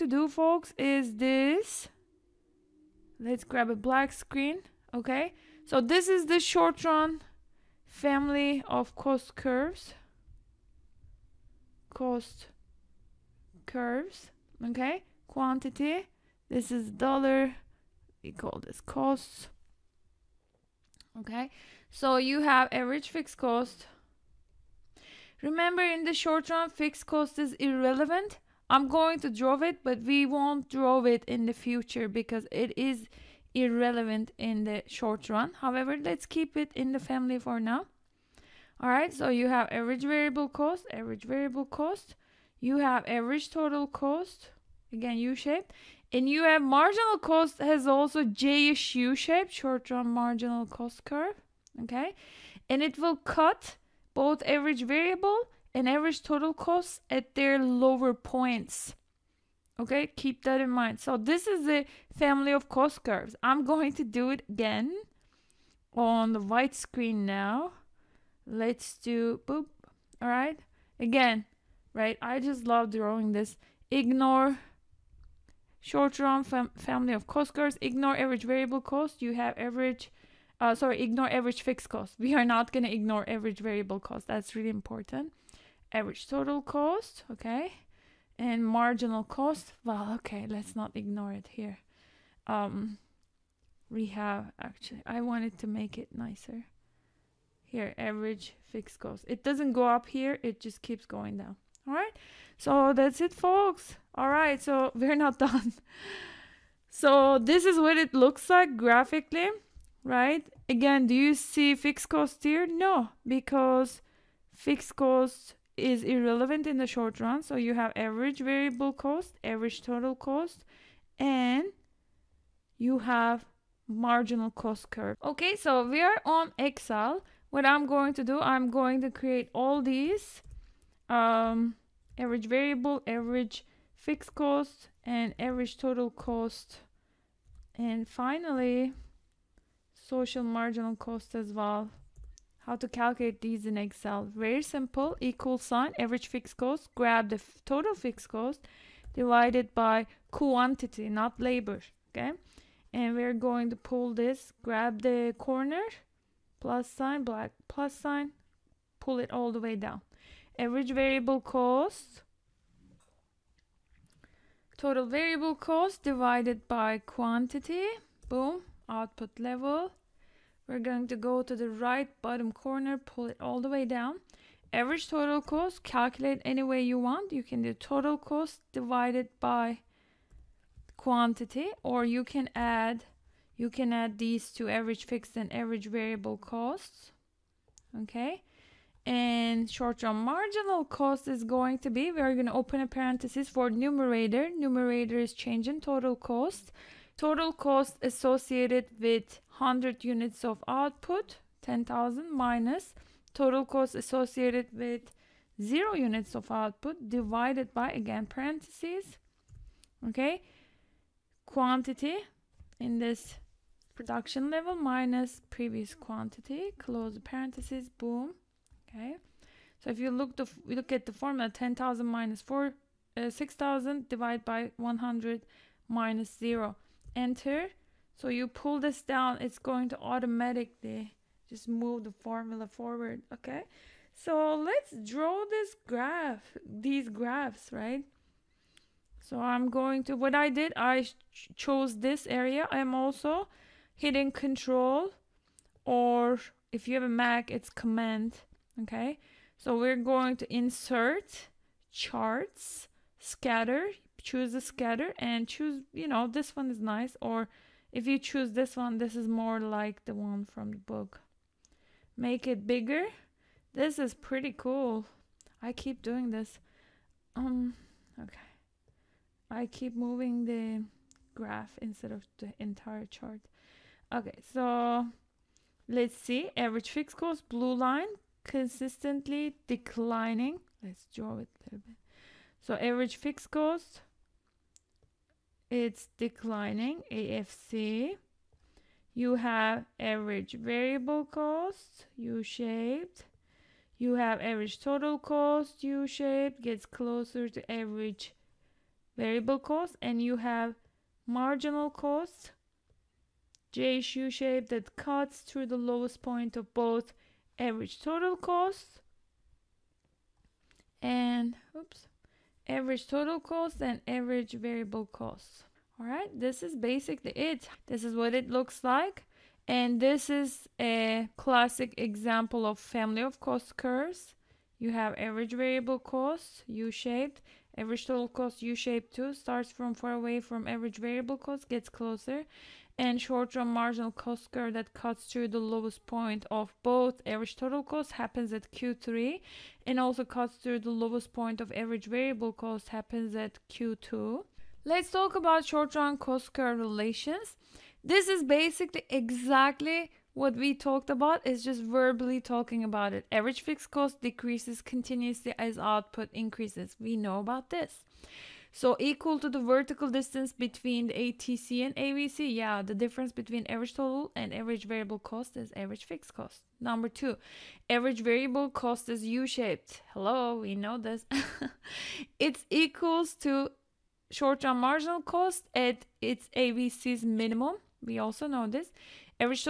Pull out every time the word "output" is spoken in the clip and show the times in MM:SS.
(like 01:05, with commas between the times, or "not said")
02:48, 03:20, 03:26, 05:55.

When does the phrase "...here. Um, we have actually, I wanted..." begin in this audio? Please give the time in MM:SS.
01:31.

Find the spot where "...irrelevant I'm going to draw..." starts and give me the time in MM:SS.
00:27.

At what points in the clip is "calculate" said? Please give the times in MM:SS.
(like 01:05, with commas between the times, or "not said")
02:22, 02:55.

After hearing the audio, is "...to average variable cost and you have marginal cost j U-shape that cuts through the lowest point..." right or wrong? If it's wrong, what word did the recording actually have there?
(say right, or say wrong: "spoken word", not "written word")
right.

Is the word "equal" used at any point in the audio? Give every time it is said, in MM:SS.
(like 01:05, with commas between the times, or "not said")
02:25, 05:58, 06:12.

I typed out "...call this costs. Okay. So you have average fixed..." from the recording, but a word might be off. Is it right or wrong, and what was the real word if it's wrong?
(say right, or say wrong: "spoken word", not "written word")
right.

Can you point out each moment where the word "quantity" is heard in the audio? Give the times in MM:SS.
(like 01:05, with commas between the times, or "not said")
00:15, 02:30, 02:46, 03:00, 03:31, 03:35.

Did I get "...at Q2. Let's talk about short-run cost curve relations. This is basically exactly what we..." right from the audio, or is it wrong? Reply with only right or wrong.
right.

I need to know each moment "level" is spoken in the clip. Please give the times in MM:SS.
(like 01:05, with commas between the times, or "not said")
02:49, 03:34.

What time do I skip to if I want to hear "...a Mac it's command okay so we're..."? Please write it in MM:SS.
04:07.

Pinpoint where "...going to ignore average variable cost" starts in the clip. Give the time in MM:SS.
01:22.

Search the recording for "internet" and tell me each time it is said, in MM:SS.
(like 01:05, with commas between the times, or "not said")
not said.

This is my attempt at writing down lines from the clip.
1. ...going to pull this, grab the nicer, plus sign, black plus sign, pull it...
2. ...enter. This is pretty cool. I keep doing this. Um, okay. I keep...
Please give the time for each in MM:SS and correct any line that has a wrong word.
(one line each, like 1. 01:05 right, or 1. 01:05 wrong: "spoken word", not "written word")
1. 02:33 wrong: "corner", not "nicer"
2. 04:22 wrong: "bigger", not "enter".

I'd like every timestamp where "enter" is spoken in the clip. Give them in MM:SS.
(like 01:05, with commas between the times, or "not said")
03:47.